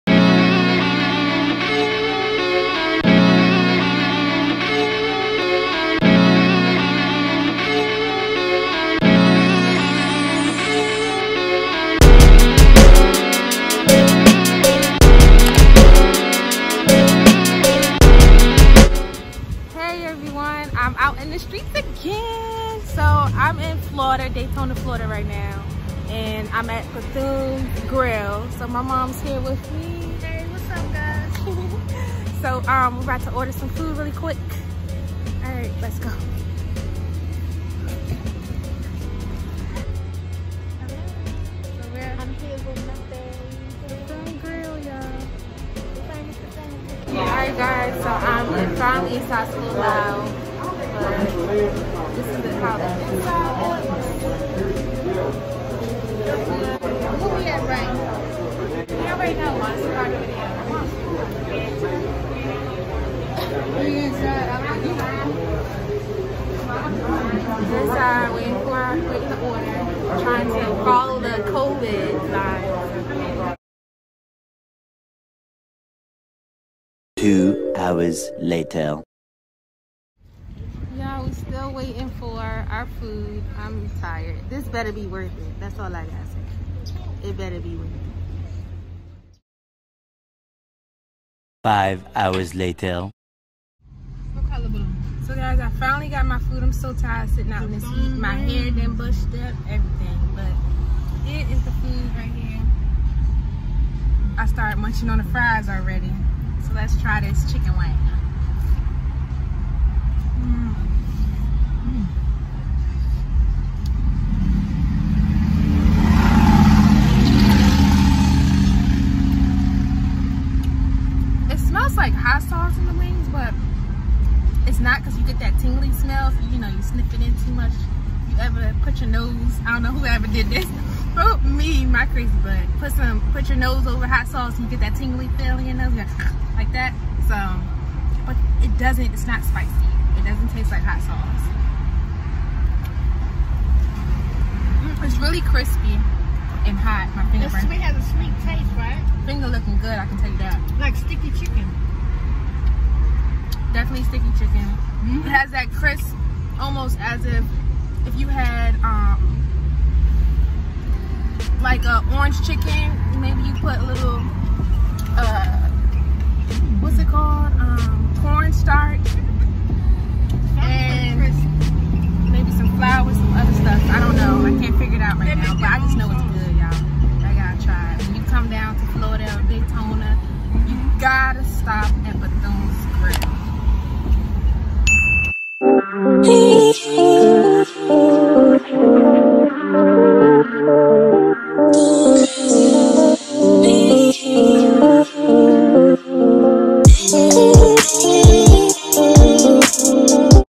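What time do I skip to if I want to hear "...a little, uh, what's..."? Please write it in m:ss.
2:43.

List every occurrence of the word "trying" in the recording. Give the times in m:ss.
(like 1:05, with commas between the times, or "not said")
1:10.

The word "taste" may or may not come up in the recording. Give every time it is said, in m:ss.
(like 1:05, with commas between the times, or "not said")
2:20, 2:28.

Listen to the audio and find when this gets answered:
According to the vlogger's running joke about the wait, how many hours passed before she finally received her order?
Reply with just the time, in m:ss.
1:31.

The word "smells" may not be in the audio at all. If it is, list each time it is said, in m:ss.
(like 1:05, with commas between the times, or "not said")
2:01, 2:05.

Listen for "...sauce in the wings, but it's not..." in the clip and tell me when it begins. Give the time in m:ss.
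2:02.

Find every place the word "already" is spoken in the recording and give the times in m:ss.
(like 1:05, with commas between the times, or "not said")
0:59, 1:45.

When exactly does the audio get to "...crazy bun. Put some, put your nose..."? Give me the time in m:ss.
2:12.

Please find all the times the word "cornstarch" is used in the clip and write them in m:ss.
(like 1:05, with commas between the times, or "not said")
2:48.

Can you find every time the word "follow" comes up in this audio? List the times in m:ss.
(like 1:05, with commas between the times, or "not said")
1:10.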